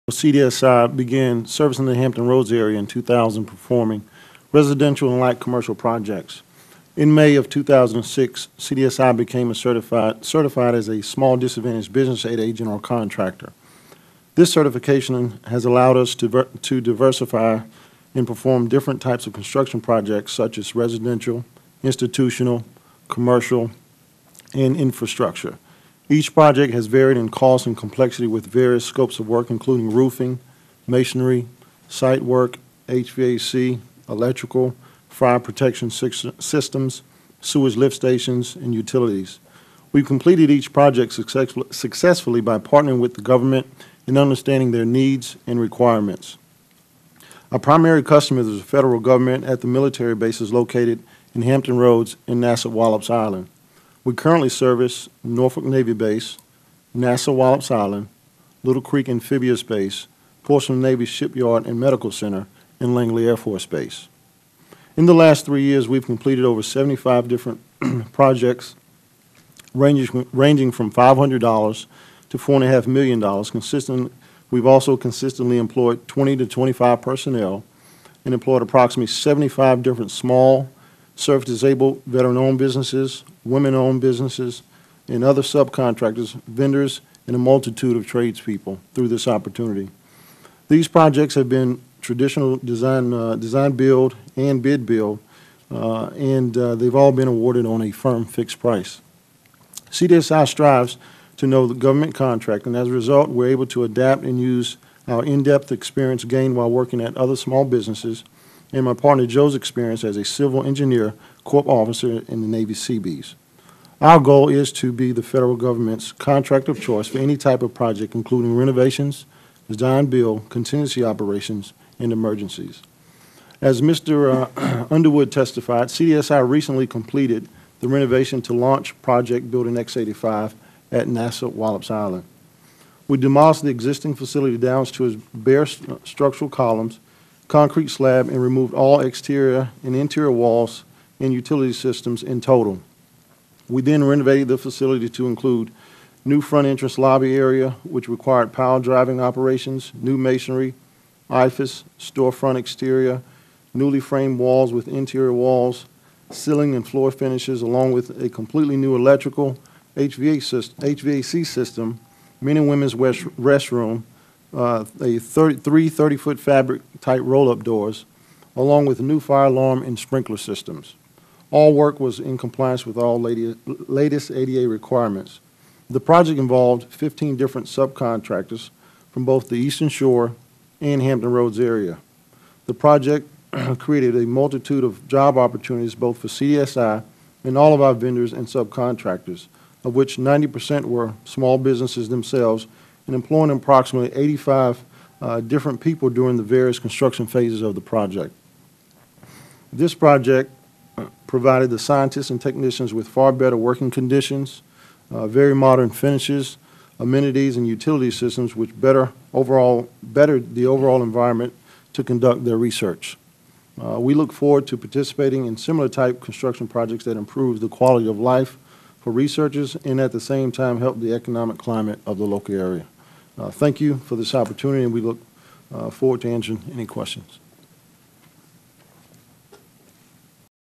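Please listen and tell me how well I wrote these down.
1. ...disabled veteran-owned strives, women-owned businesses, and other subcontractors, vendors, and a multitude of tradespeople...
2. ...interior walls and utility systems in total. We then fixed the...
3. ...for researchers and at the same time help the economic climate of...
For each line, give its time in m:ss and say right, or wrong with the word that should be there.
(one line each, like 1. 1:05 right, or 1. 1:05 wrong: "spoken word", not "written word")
1. 1:21 wrong: "businesses", not "strives"
2. 2:19 wrong: "renovated", not "fixed"
3. 3:38 right.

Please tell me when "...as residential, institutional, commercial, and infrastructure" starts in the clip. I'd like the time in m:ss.
0:20.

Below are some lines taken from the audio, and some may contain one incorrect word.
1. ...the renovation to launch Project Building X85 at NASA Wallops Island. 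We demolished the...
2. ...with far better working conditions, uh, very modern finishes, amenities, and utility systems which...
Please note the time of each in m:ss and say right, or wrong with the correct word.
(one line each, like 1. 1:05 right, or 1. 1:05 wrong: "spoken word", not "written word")
1. 2:07 right
2. 3:22 right.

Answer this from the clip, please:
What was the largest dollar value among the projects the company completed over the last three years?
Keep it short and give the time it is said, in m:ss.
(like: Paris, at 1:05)
$4.5 million, at 1:12.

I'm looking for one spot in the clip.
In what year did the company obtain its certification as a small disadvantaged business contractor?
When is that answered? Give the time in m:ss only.
0:07.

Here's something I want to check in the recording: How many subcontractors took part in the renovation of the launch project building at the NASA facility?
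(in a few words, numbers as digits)
15.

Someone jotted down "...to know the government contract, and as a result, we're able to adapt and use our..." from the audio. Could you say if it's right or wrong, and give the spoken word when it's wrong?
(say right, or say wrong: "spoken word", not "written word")
right.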